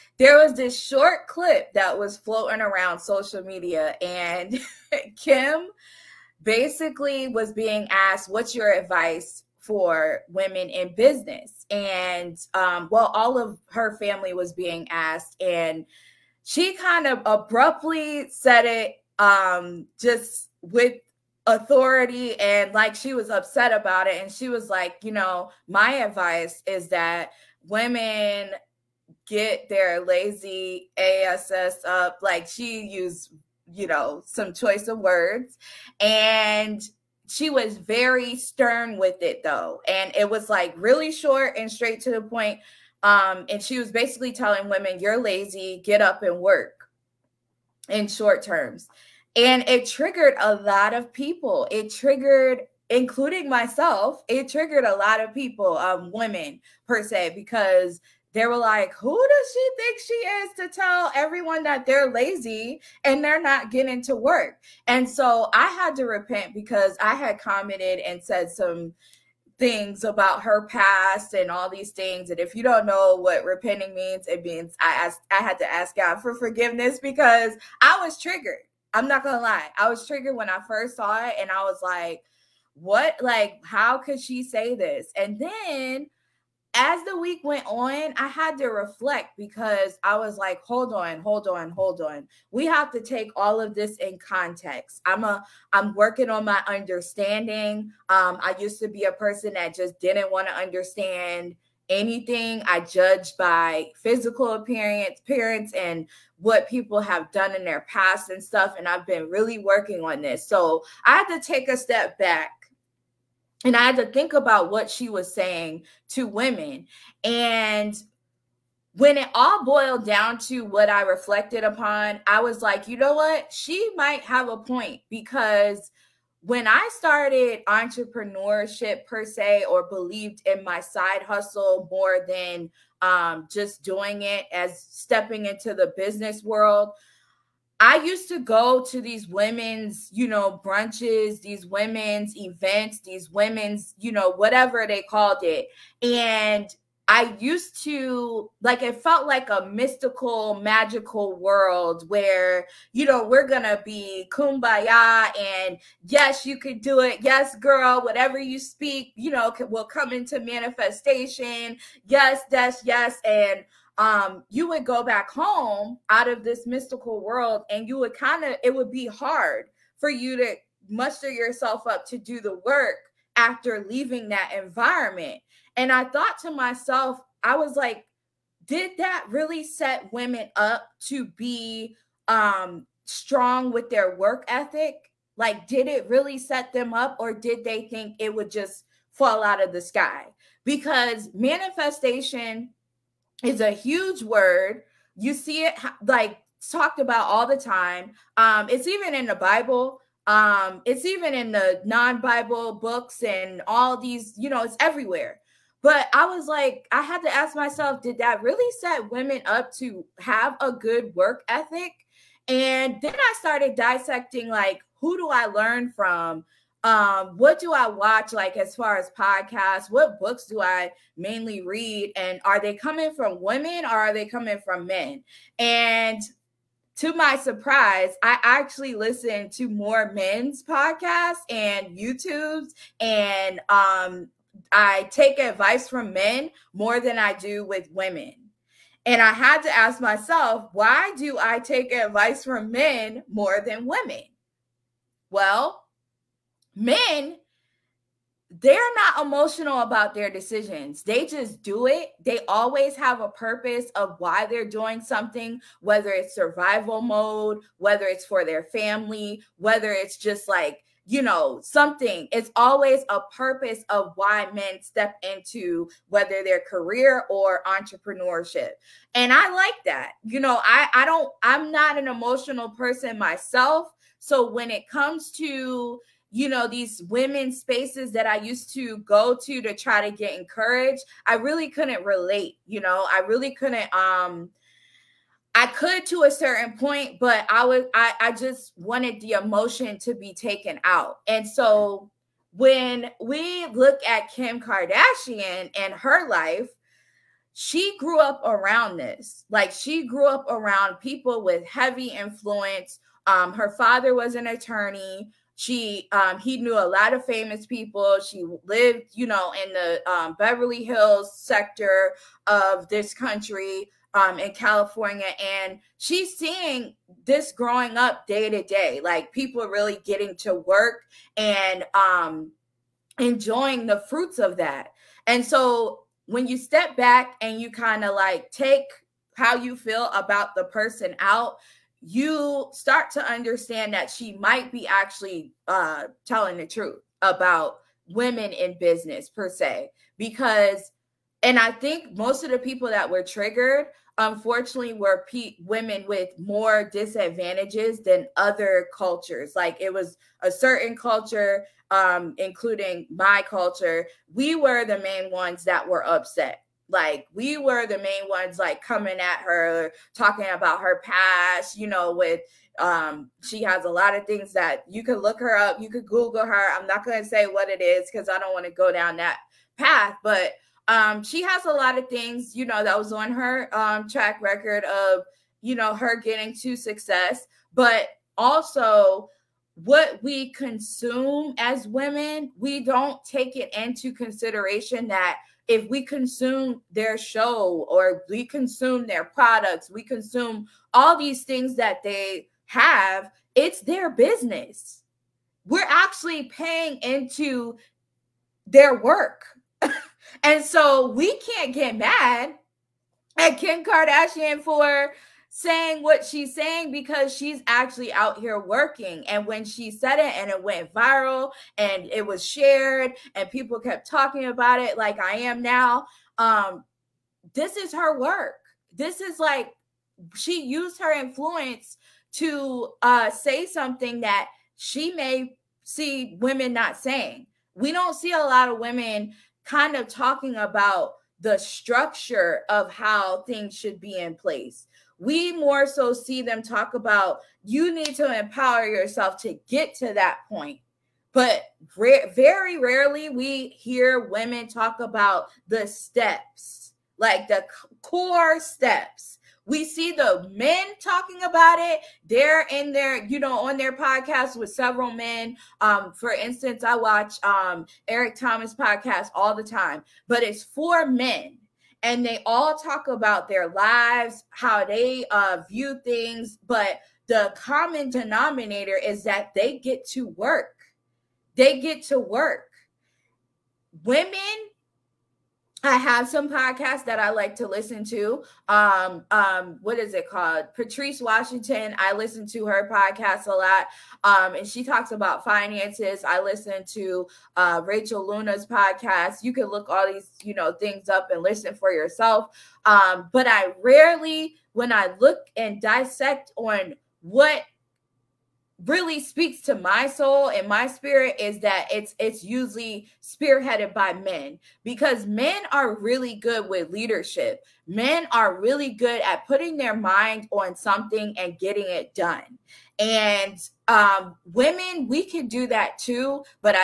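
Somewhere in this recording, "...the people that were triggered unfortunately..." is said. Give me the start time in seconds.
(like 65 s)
342 s.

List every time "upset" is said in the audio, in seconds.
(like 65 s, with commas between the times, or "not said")
23 s, 356 s.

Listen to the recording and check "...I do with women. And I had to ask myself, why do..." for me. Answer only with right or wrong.
right.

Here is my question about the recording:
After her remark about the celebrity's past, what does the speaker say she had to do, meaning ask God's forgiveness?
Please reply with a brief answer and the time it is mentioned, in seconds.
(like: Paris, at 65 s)
Repent, at 66 s.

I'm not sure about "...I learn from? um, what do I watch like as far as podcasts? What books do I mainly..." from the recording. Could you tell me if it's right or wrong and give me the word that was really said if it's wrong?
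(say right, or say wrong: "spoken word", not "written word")
right.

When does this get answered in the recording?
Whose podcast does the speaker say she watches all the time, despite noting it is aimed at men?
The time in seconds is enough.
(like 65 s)
458 s.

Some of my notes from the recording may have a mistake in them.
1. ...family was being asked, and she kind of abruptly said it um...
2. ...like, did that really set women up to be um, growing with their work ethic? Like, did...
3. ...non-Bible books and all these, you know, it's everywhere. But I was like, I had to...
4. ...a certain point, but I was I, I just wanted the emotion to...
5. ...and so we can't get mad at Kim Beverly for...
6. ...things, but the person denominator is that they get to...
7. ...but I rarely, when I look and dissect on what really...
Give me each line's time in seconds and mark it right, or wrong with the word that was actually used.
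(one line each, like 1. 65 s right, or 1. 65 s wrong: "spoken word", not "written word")
1. 13 s right
2. 177 s wrong: "strong", not "growing"
3. 201 s right
4. 286 s right
5. 400 s wrong: "Kardashian", not "Beverly"
6. 466 s wrong: "common", not "person"
7. 493 s right.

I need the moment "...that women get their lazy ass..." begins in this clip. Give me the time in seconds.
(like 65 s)
26 s.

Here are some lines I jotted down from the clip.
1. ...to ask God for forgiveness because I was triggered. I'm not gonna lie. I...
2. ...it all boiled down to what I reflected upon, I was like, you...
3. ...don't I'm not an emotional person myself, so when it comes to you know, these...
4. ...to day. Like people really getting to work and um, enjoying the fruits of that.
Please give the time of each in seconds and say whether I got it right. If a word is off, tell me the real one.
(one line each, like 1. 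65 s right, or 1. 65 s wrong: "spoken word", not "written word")
1. 75 s right
2. 119 s right
3. 271 s right
4. 318 s right.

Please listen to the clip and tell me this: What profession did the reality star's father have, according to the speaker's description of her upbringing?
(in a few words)
Attorney.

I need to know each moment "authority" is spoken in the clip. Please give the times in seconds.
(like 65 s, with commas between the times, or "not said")
21 s.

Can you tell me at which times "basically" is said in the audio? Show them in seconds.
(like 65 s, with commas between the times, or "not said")
6 s, 43 s.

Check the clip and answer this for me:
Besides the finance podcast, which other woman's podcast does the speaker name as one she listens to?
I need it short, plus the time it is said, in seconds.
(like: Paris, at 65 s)
Rachel Luna, at 487 s.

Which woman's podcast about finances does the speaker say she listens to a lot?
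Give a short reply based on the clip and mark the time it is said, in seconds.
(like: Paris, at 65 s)
Patrice Washington, at 480 s.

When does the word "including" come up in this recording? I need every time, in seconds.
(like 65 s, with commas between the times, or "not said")
52 s, 352 s.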